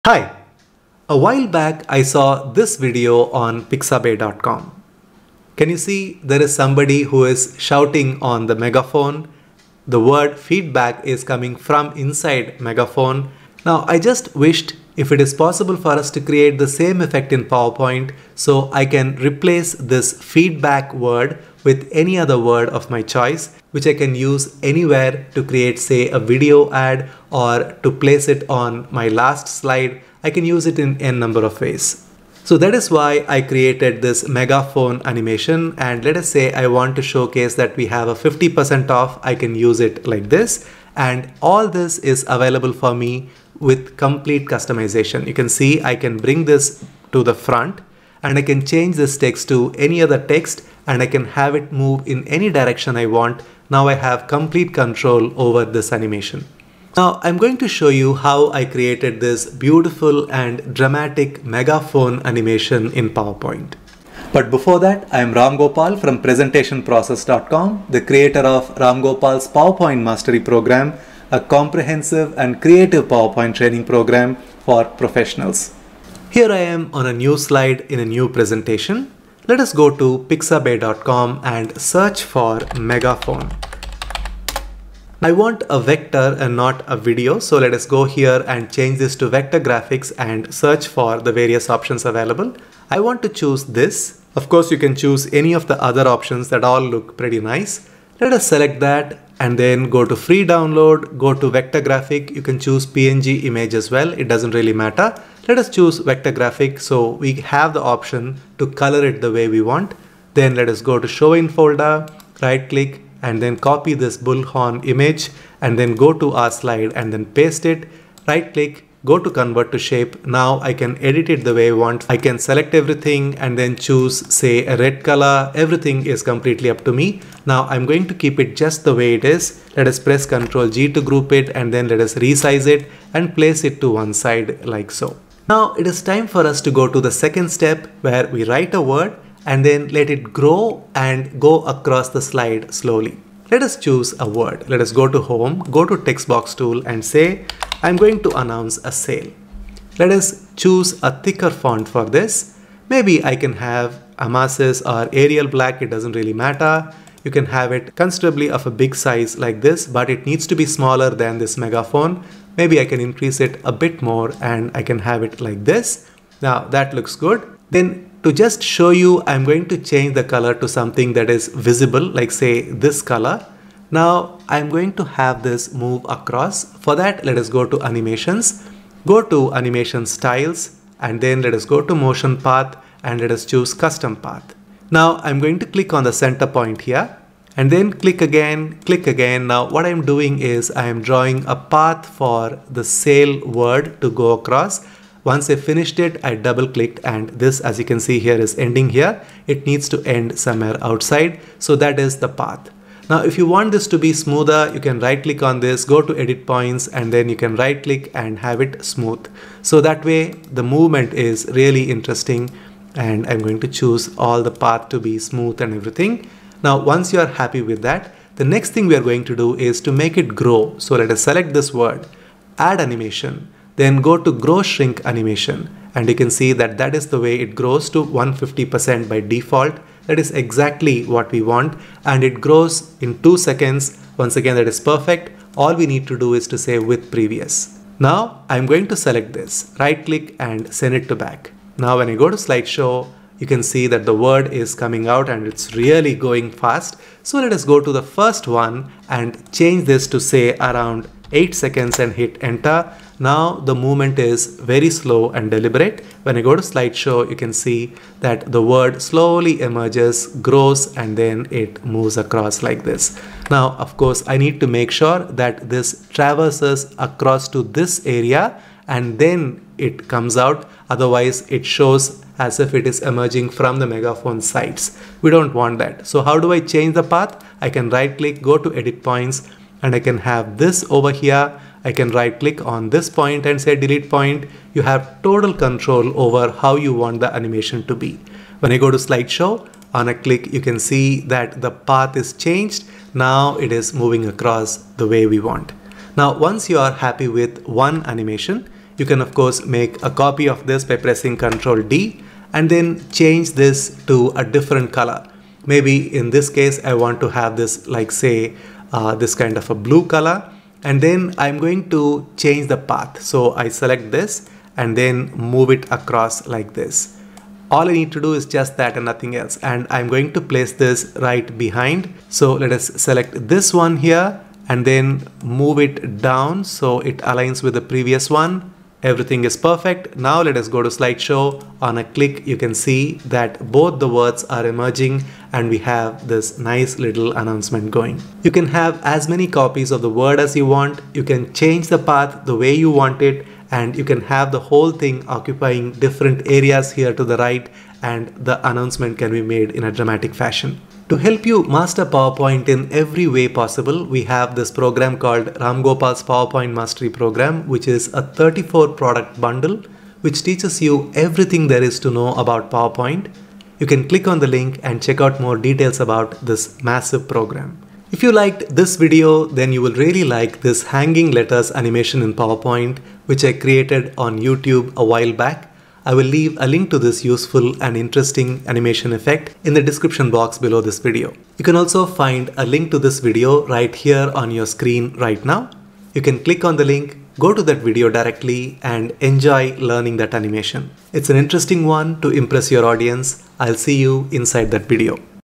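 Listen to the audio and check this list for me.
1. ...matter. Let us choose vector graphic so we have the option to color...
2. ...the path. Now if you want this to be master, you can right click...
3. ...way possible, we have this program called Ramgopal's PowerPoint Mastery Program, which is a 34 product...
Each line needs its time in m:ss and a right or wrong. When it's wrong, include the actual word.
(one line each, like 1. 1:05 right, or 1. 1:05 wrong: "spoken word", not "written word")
1. 1:44 right
2. 3:22 wrong: "smoother", not "master"
3. 5:53 right.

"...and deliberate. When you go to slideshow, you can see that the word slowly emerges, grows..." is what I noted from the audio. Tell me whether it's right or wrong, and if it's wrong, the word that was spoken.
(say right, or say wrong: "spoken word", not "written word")
right.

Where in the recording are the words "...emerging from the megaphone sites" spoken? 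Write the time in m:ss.
4:33.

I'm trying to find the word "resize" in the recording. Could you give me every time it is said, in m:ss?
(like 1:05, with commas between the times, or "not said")
2:12.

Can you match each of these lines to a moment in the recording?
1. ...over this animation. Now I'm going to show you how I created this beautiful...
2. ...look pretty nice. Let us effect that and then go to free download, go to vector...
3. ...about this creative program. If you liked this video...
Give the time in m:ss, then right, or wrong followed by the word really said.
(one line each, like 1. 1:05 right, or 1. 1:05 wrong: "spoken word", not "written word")
1. 0:55 right
2. 1:36 wrong: "select", not "effect"
3. 6:05 wrong: "massive", not "creative".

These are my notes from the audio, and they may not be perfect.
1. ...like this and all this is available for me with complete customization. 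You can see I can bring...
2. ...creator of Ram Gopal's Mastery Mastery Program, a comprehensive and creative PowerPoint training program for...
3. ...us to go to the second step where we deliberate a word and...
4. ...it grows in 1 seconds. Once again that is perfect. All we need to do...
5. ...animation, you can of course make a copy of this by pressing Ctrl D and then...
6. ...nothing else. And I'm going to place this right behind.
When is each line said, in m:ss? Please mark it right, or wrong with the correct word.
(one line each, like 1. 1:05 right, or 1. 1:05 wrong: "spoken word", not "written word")
1. 0:40 right
2. 1:08 wrong: "PowerPoint", not "Mastery"
3. 2:16 wrong: "write", not "deliberate"
4. 3:52 wrong: "2", not "1"
5. 4:58 right
6. 5:19 right.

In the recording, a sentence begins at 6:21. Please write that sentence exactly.
You can also find a link to this video right here on your screen right now.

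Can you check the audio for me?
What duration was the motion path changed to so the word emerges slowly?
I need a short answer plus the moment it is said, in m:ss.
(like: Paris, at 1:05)
8 seconds, at 4:11.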